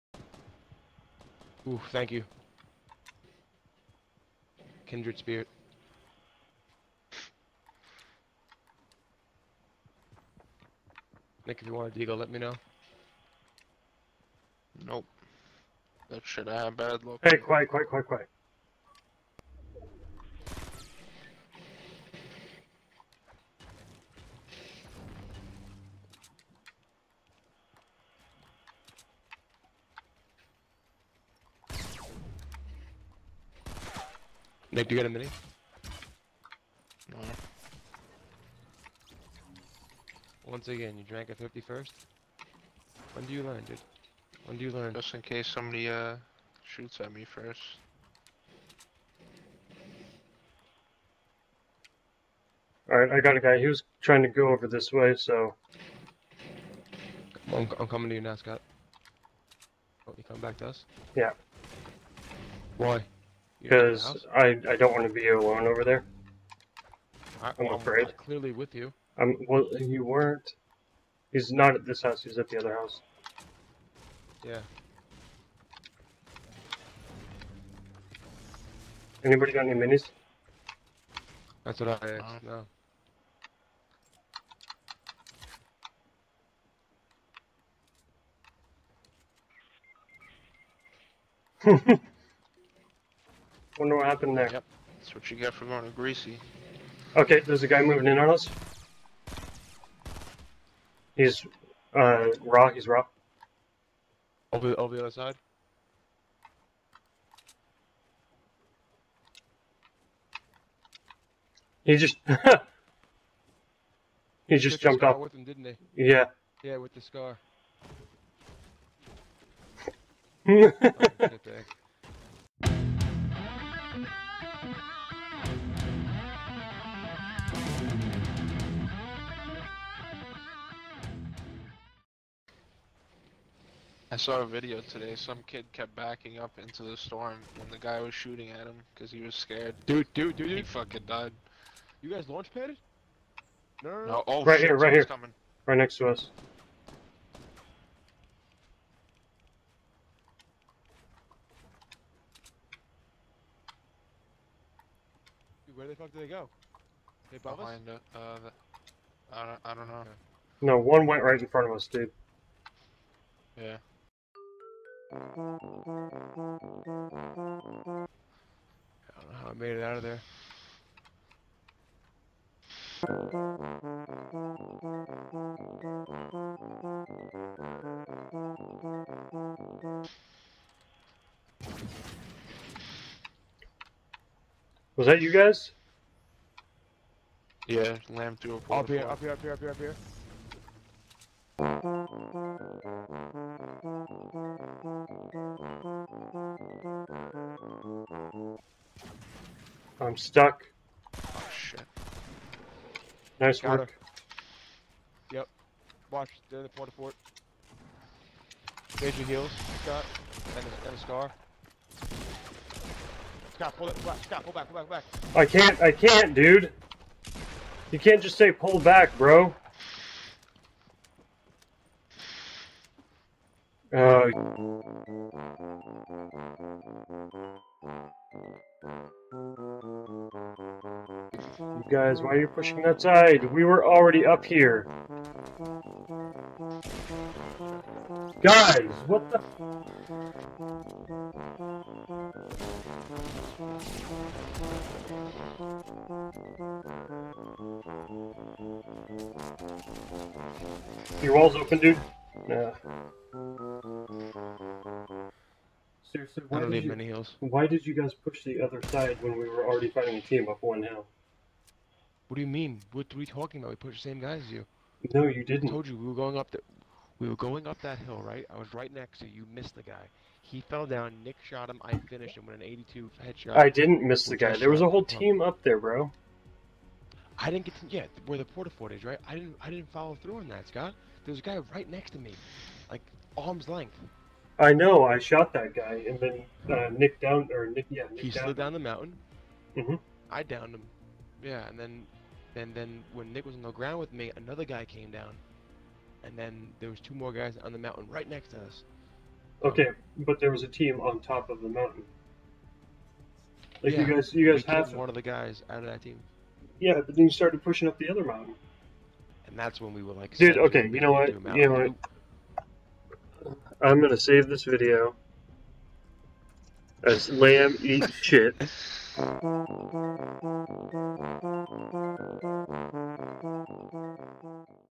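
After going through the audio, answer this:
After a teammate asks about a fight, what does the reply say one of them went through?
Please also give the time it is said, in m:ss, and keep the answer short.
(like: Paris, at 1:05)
A portal, at 3:08.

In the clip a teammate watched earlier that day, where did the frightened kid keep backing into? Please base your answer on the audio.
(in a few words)
The storm.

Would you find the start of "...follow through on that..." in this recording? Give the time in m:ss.
4:39.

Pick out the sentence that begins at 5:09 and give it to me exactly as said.
And that's when we were like, dude, okay, you know what, you know what.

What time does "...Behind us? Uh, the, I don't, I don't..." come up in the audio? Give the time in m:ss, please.
2:37.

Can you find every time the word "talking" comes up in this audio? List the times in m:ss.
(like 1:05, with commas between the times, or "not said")
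4:23.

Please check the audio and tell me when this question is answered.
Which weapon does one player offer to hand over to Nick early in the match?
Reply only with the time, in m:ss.
0:11.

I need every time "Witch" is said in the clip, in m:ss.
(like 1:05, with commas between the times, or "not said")
not said.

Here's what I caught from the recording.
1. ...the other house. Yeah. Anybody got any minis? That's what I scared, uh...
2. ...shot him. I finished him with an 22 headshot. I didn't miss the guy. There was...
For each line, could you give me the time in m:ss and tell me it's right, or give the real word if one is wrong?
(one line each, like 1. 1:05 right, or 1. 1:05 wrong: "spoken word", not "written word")
1. 1:12 wrong: "asked", not "scared"
2. 4:31 wrong: "82", not "22".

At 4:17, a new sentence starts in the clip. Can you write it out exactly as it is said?
Why did you guys push the other side when we were already fighting a team up one hill?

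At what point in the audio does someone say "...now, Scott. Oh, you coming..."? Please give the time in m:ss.
0:58.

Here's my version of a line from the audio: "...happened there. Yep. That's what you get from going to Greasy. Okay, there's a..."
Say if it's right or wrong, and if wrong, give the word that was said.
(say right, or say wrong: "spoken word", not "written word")
right.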